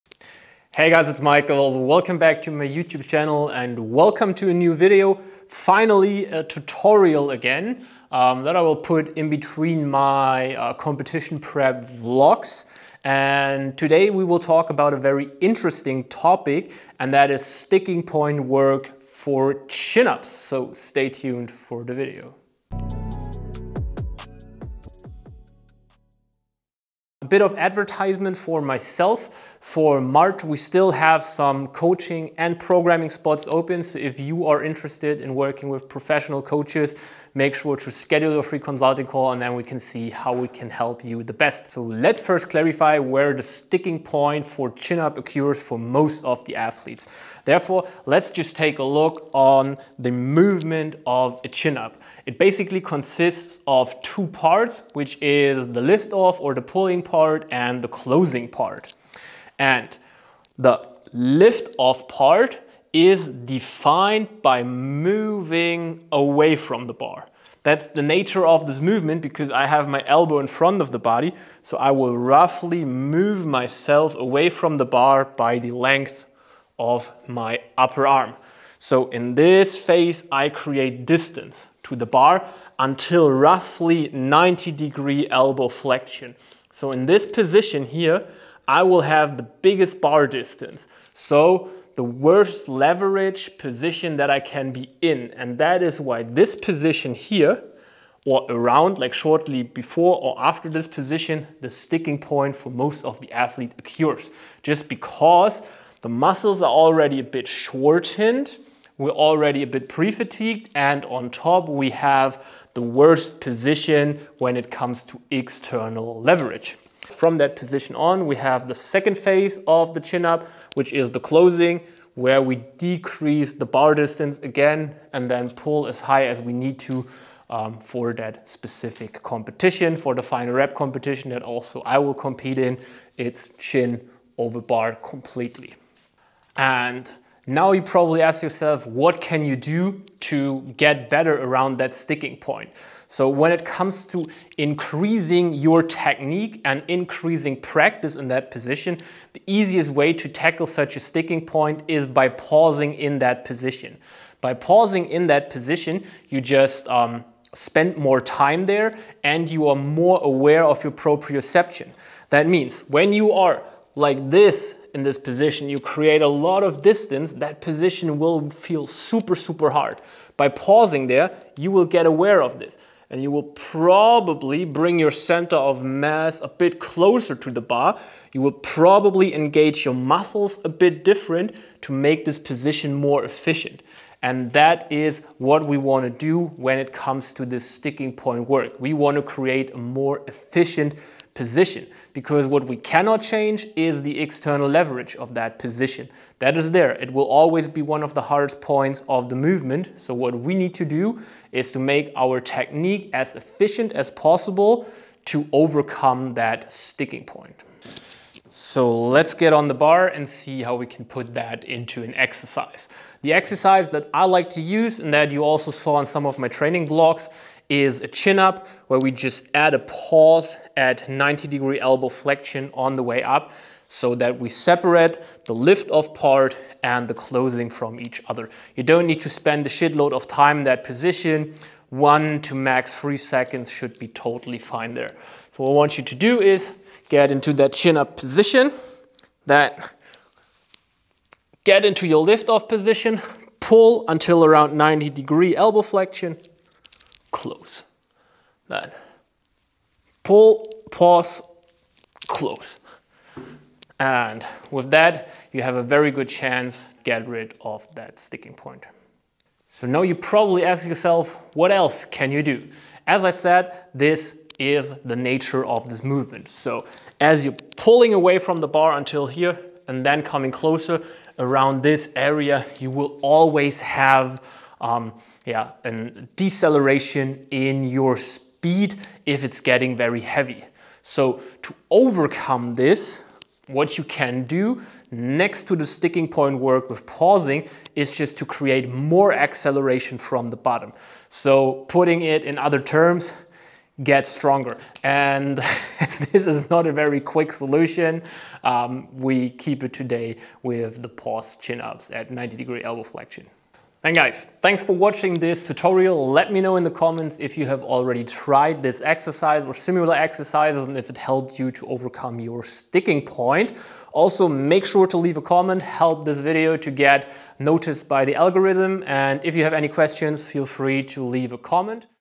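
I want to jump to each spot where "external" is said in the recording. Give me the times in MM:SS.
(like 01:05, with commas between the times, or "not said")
01:55, 03:14.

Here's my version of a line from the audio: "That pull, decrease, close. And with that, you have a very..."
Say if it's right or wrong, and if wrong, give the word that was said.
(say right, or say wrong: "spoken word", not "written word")
wrong: "pause", not "decrease".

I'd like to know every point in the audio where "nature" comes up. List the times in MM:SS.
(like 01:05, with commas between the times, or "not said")
01:08, 04:25.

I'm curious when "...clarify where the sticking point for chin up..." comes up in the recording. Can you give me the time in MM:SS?
00:42.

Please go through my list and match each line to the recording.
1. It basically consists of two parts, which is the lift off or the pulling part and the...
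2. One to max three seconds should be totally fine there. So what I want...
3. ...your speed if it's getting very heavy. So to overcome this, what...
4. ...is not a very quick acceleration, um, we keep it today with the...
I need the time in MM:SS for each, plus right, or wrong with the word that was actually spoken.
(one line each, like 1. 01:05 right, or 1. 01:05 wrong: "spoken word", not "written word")
1. 00:52 right
2. 03:51 right
3. 04:37 right
4. 04:56 wrong: "solution", not "acceleration".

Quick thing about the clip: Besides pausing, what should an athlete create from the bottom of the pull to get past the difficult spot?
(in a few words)
more acceleration.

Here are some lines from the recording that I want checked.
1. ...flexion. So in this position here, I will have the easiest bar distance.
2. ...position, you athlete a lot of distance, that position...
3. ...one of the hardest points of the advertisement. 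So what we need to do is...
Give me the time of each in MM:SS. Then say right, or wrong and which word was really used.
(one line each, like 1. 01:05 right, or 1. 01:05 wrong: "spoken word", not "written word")
1. 01:25 wrong: "biggest", not "easiest"
2. 02:45 wrong: "create", not "athlete"
3. 03:17 wrong: "movement", not "advertisement".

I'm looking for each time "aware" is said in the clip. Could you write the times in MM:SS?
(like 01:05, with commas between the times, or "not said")
02:40, 02:52.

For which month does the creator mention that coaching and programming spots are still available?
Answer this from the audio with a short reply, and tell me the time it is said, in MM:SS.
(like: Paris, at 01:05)
March, at 00:30.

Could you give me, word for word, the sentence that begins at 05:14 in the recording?
Also, make sure to leave a comment, help this video to get noticed by the algorithm.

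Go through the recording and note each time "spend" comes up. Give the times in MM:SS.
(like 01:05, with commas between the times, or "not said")
02:37, 03:49.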